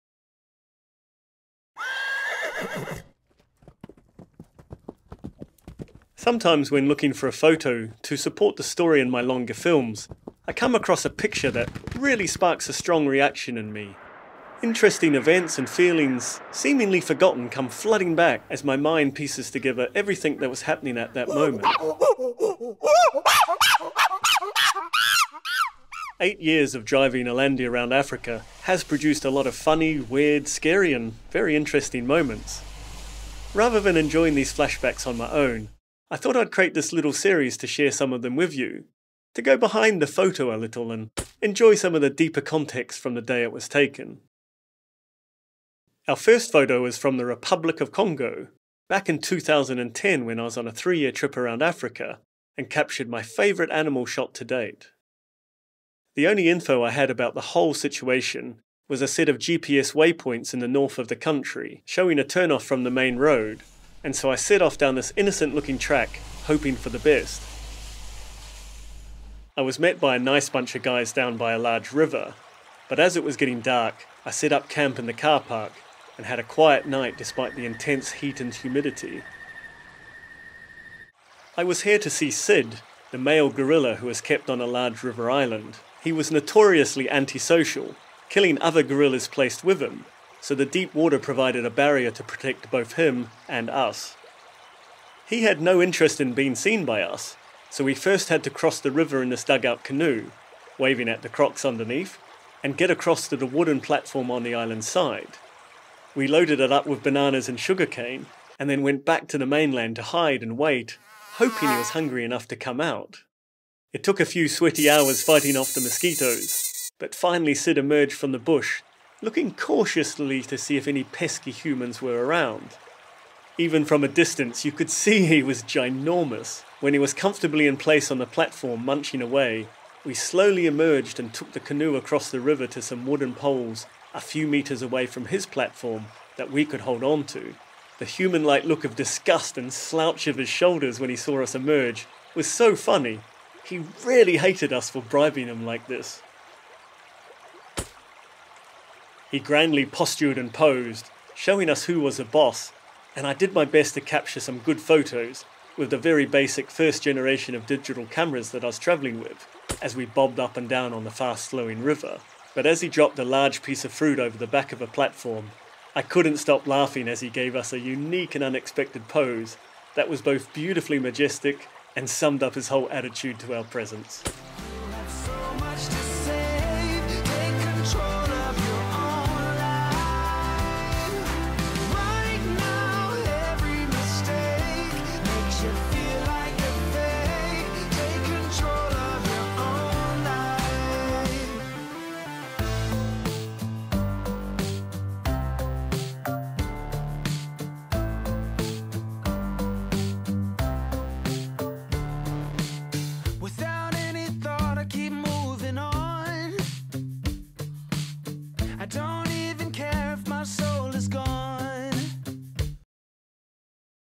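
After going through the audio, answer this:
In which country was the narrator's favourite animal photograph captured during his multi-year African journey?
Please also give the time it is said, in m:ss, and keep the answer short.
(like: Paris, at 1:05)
Republic of Congo, at 0:47.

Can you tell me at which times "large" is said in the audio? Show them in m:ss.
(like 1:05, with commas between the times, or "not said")
1:11, 1:24, 2:43.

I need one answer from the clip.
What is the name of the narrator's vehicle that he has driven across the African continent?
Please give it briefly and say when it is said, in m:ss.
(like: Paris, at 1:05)
Alandi, at 0:27.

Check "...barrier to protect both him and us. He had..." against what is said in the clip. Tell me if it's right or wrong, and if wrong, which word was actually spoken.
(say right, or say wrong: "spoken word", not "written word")
right.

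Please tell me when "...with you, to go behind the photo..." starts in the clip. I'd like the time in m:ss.
0:38.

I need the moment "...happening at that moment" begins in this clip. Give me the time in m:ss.
0:20.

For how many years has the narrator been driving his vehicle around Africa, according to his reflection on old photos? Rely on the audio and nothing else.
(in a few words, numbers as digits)
8.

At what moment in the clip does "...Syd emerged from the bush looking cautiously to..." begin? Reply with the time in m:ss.
1:57.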